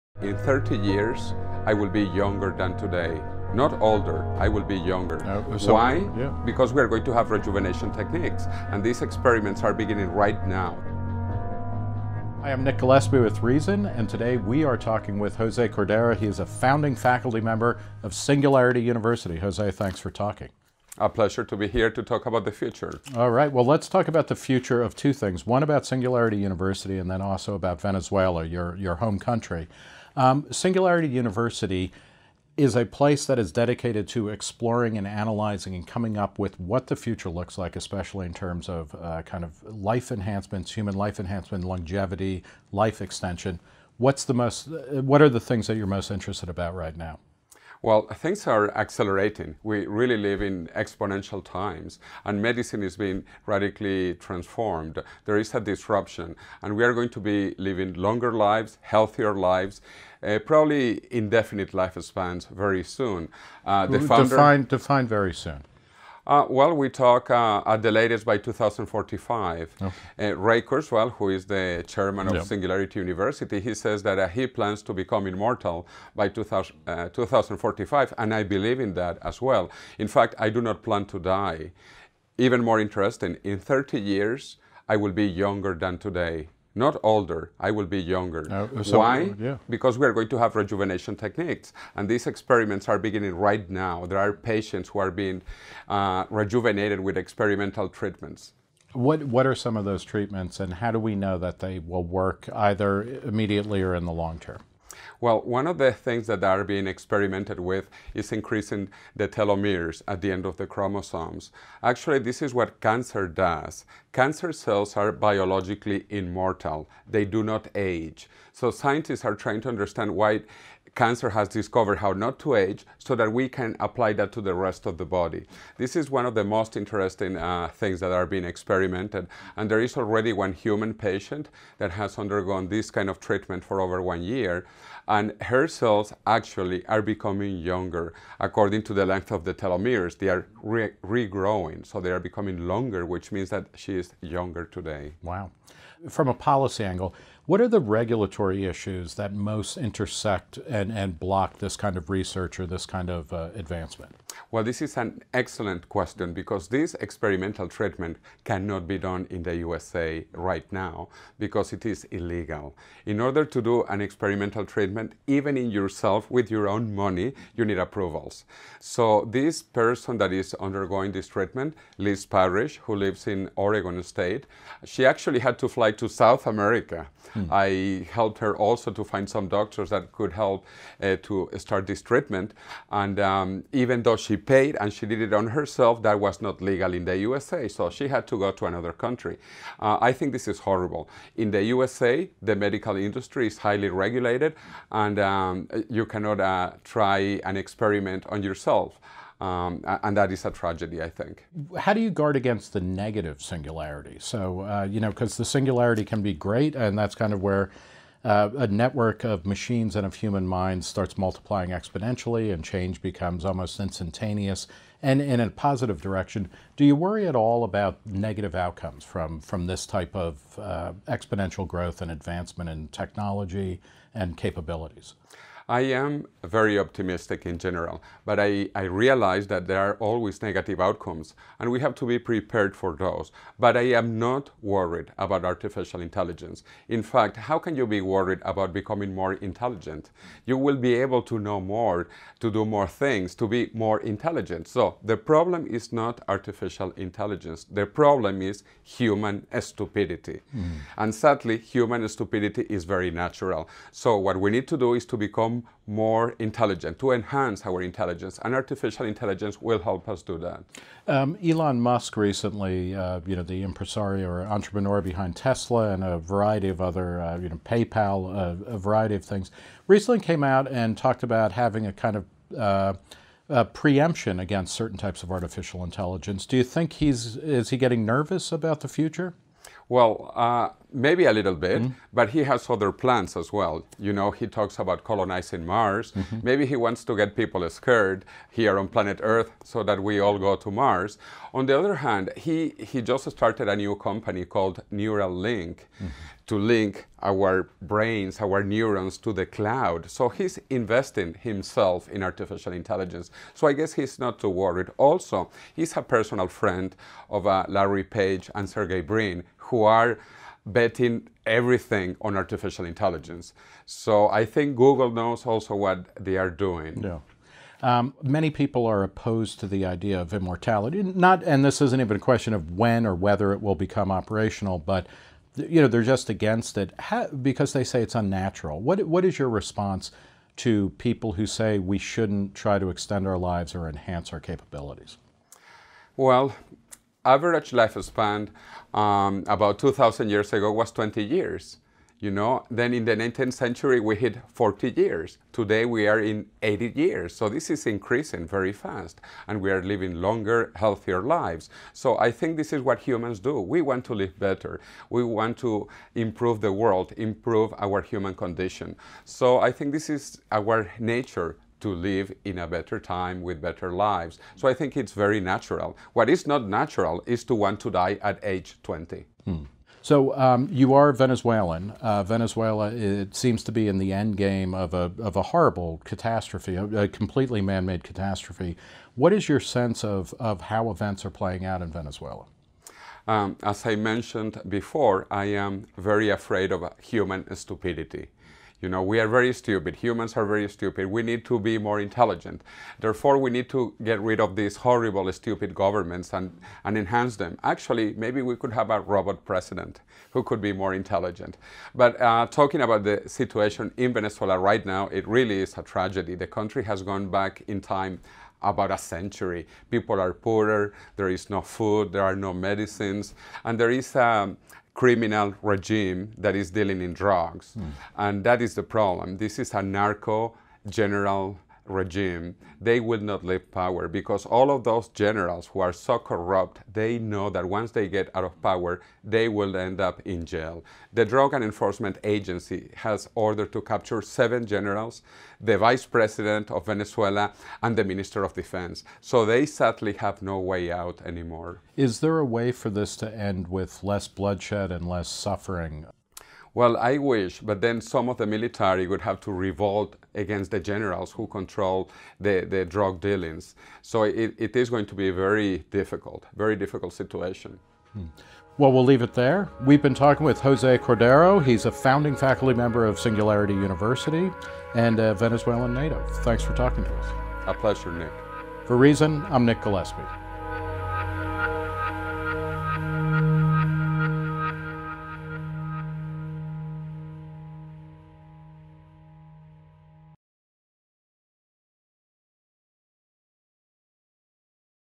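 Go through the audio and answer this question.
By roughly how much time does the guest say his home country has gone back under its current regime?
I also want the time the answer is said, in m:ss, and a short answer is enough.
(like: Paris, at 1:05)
a century, at 6:48.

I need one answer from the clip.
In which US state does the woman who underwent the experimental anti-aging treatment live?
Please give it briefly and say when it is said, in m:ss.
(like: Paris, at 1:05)
Oregon, at 2:53.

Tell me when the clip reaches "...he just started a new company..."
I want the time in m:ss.
4:52.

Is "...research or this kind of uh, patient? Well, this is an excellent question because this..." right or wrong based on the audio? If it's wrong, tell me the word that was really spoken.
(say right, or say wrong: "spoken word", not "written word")
wrong: "advancement", not "patient".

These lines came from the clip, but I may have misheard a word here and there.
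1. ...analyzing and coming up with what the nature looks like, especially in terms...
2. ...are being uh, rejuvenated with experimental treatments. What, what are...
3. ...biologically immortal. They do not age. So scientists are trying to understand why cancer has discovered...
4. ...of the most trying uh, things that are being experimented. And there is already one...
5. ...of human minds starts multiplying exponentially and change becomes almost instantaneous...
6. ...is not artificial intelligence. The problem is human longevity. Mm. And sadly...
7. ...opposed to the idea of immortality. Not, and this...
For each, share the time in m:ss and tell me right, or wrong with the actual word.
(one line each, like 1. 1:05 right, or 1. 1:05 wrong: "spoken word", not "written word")
1. 0:35 wrong: "future", not "nature"
2. 1:34 right
3. 1:55 right
4. 2:06 wrong: "interesting", not "trying"
5. 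3:30 right
6. 4:05 wrong: "stupidity", not "longevity"
7. 5:19 right.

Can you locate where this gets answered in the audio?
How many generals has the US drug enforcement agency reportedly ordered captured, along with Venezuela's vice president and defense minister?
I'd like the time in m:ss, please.
7:14.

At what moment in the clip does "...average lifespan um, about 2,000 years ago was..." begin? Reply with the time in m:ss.
5:37.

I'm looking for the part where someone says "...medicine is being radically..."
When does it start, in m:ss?
0:52.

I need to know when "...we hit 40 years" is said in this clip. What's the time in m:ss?
5:43.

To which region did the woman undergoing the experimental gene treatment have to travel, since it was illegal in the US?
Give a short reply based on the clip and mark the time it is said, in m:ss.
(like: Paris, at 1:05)
South America, at 2:56.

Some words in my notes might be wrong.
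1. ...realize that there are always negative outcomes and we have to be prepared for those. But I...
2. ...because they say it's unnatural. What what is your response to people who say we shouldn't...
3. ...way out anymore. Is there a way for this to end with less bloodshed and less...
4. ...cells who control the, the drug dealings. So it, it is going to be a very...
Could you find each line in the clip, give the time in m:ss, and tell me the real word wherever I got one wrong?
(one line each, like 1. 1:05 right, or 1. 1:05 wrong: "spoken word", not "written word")
1. 3:48 right
2. 5:27 right
3. 7:20 right
4. 7:30 wrong: "generals", not "cells".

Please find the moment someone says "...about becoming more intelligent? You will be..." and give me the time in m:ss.
3:58.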